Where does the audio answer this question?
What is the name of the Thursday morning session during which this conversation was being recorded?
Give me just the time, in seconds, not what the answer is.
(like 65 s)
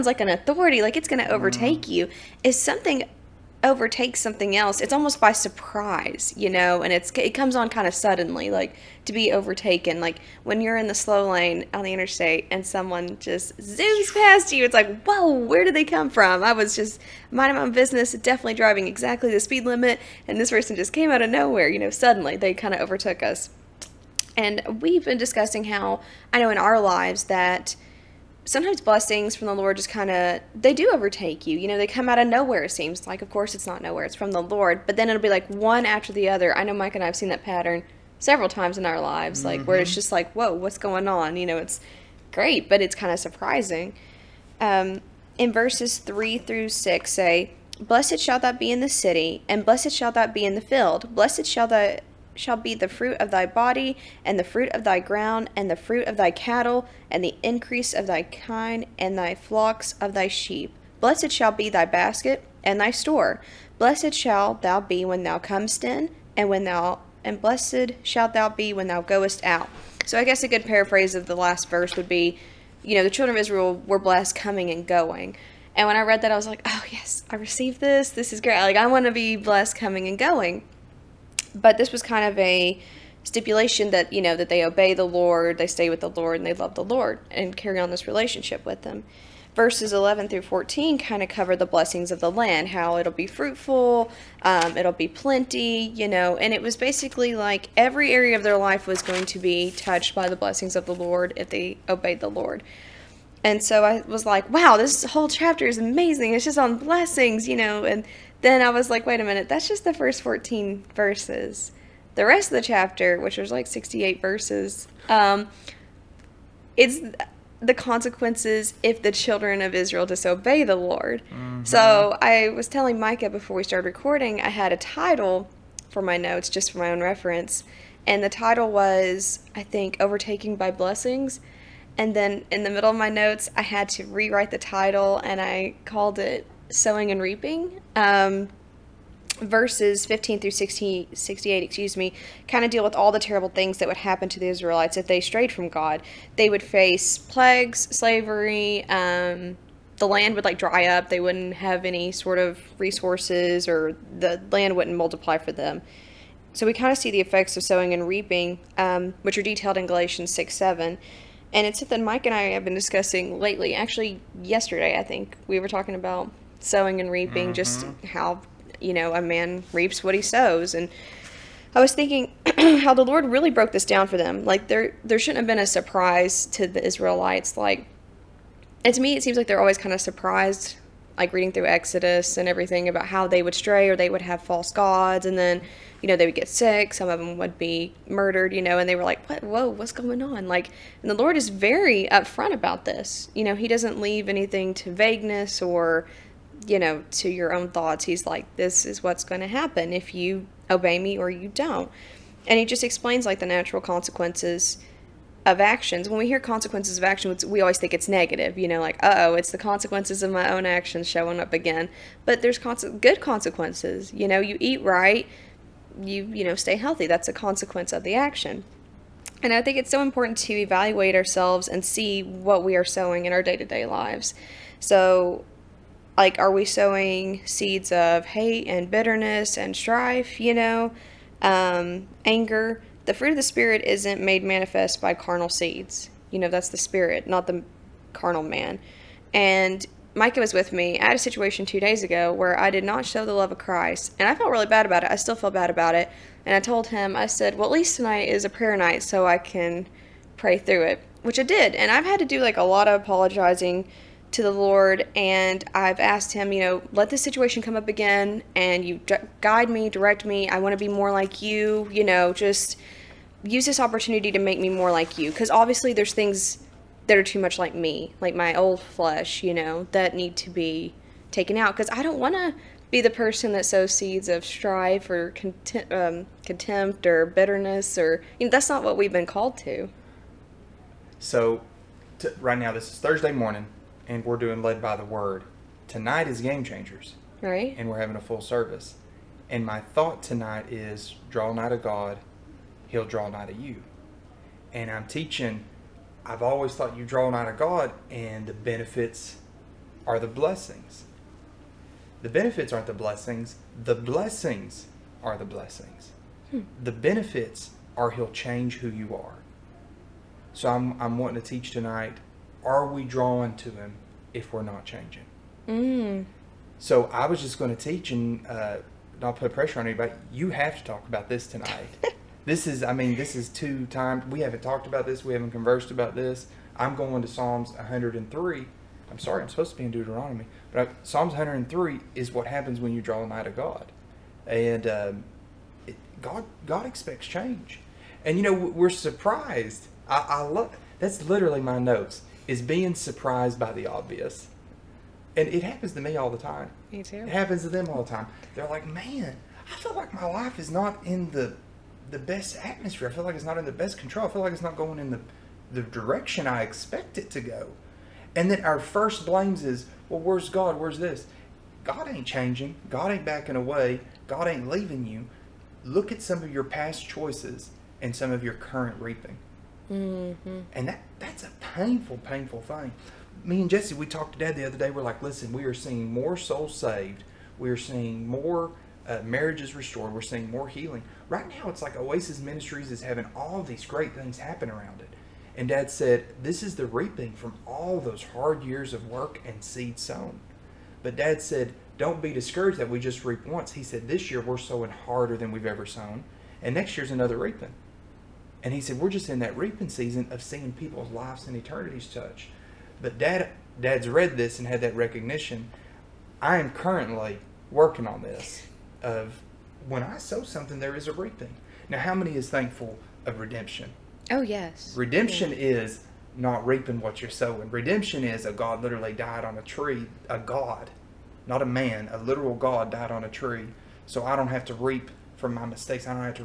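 284 s.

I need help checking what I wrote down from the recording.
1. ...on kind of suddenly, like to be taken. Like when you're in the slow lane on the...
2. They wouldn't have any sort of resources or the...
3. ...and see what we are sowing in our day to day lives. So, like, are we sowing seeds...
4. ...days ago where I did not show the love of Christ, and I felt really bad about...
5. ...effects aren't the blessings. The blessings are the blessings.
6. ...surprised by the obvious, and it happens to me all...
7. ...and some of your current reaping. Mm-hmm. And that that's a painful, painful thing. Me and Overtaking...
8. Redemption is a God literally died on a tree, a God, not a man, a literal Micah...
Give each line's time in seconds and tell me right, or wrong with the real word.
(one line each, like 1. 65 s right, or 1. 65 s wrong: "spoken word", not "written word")
1. 7 s wrong: "overtaken", not "taken"
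2. 151 s right
3. 221 s right
4. 241 s right
5. 302 s wrong: "benefits", not "effects"
6. 342 s right
7. 368 s wrong: "Jesse", not "Overtaking"
8. 417 s wrong: "God", not "Micah".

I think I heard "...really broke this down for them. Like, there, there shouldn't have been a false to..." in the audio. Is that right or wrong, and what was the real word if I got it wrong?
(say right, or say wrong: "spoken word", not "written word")
wrong: "surprise", not "false".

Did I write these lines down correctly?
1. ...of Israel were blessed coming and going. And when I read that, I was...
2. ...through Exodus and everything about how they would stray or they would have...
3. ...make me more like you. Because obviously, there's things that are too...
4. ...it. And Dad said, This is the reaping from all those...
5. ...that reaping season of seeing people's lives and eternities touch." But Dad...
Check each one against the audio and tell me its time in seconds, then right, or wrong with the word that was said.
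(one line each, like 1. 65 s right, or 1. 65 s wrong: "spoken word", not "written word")
1. 73 s right
2. 181 s right
3. 264 s right
4. 385 s right
5. 399 s right.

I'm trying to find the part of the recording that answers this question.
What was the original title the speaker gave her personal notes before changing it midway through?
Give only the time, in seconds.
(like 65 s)
129 s.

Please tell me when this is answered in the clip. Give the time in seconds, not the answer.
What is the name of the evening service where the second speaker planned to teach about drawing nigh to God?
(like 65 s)
286 s.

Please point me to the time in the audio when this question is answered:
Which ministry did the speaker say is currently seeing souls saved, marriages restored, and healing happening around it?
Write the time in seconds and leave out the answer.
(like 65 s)
381 s.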